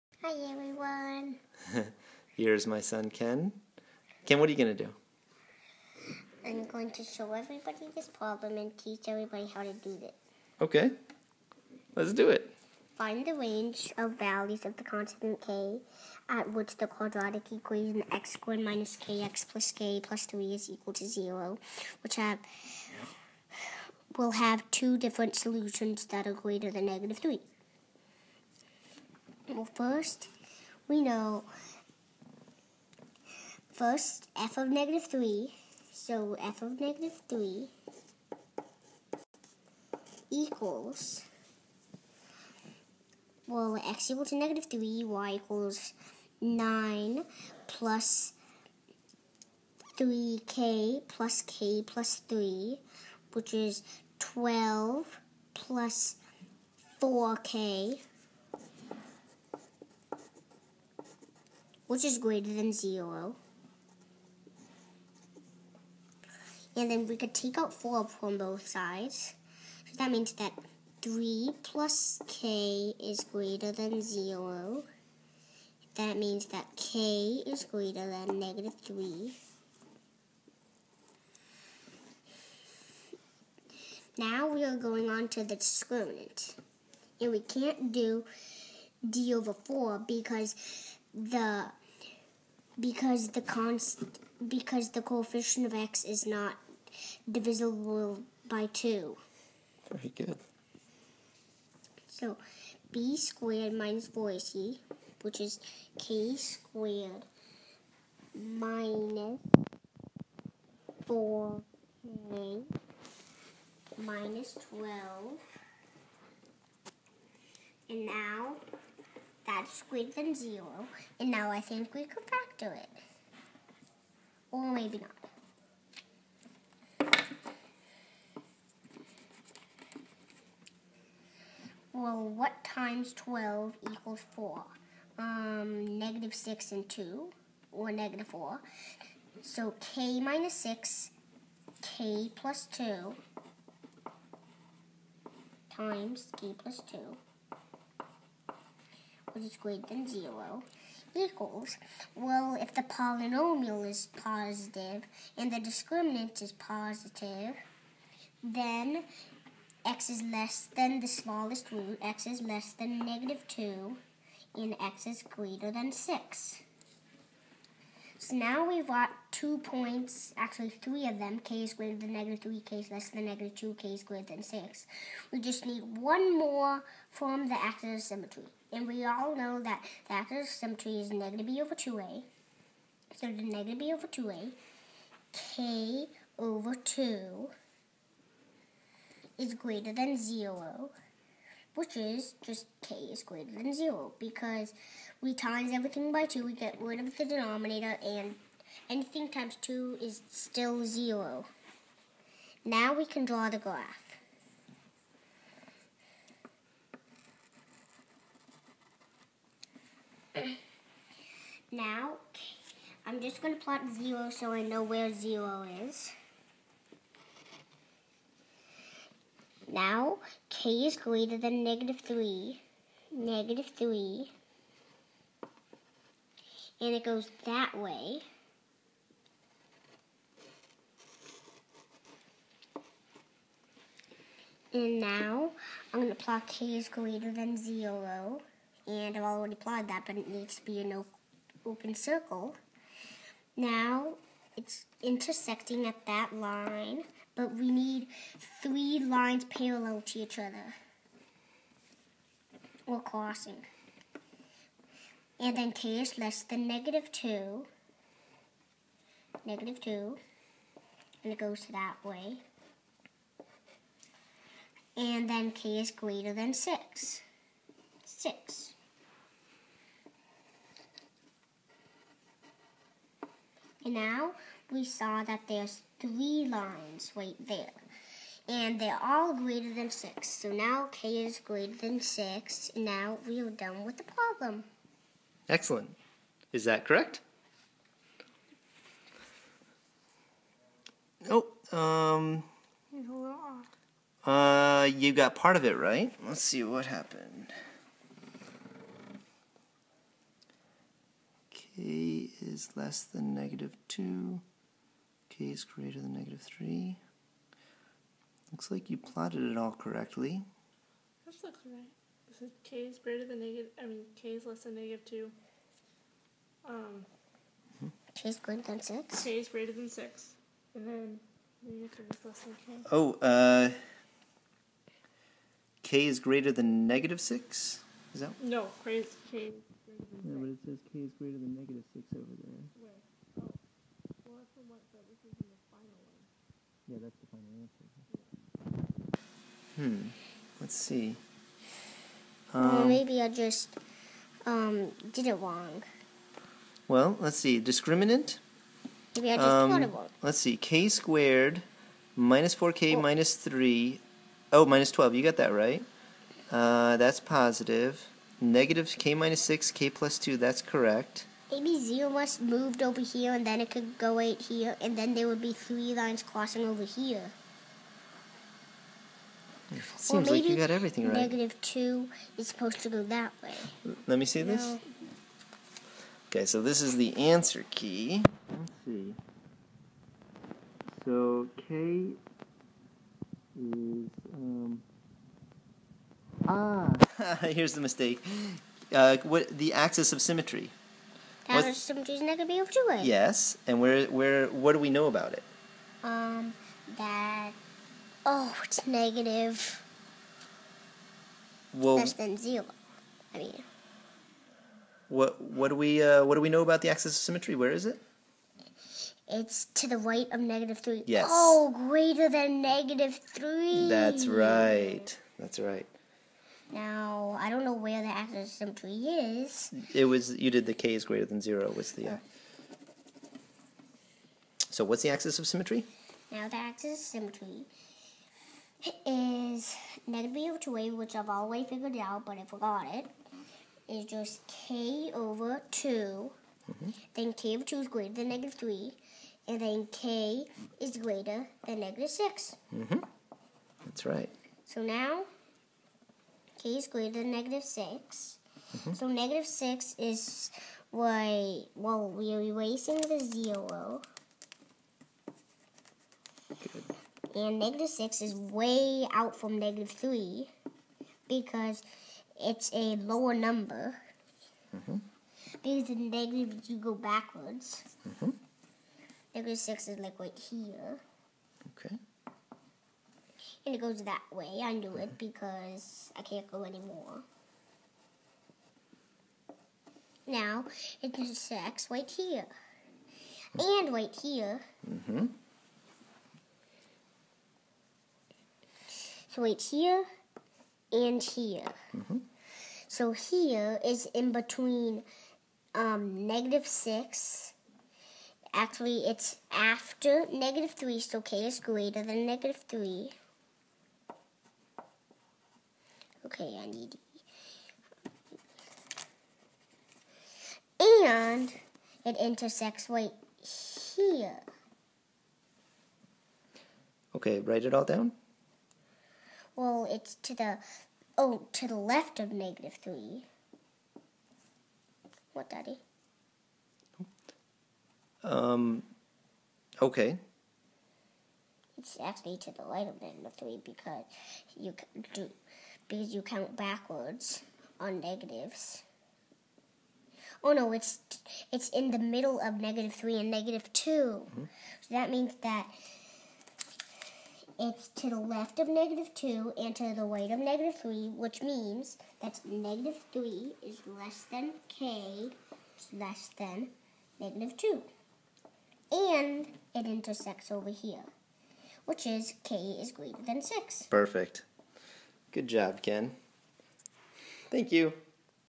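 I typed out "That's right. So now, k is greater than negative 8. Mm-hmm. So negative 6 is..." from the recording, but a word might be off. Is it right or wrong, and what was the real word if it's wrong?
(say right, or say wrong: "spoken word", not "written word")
wrong: "6", not "8".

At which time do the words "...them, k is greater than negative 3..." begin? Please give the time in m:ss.
2:51.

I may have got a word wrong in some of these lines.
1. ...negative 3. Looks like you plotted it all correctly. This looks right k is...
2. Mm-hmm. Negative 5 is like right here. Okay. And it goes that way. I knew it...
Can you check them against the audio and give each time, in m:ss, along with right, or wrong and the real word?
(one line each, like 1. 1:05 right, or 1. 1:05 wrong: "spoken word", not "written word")
1. 5:06 right
2. 7:48 wrong: "6", not "5".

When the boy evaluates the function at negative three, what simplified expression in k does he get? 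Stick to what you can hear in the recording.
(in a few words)
12 + 4k.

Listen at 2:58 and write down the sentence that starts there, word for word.
And we all know that the axis of symmetry is negative b over 2a.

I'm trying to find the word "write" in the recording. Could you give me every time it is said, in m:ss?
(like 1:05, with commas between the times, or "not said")
8:37.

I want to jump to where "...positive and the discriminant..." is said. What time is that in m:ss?
2:34.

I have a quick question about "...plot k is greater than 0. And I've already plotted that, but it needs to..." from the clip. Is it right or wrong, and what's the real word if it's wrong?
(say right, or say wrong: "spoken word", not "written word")
right.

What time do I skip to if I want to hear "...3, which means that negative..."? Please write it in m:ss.
9:10.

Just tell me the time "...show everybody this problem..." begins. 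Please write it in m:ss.
0:07.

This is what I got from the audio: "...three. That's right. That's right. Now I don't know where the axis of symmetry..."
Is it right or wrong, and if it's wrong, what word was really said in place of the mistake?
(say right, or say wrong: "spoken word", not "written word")
right.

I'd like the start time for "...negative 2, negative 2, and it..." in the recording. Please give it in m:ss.
4:16.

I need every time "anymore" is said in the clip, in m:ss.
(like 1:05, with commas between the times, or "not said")
7:56.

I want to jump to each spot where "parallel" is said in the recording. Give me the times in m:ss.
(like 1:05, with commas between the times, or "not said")
4:09.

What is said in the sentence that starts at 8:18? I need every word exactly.
Actually, it's after negative 3, so k is greater than negative 3.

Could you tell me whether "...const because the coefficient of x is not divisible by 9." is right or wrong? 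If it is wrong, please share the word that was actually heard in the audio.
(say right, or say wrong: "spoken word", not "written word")
wrong: "2", not "9".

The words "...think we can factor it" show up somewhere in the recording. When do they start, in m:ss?
2:01.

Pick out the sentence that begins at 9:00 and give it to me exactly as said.
Oh no, it's it's in the middle of negative three and negative 2 mm-hmm.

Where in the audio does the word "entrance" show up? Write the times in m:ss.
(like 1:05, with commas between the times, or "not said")
not said.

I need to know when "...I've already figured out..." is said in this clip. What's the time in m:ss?
7:11.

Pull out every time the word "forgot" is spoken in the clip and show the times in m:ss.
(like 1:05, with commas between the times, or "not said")
7:12.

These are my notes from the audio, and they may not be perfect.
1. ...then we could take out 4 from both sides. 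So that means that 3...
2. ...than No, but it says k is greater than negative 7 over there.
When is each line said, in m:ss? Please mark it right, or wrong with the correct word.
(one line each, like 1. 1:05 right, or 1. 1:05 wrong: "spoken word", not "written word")
1. 1:06 right
2. 5:30 wrong: "6", not "7".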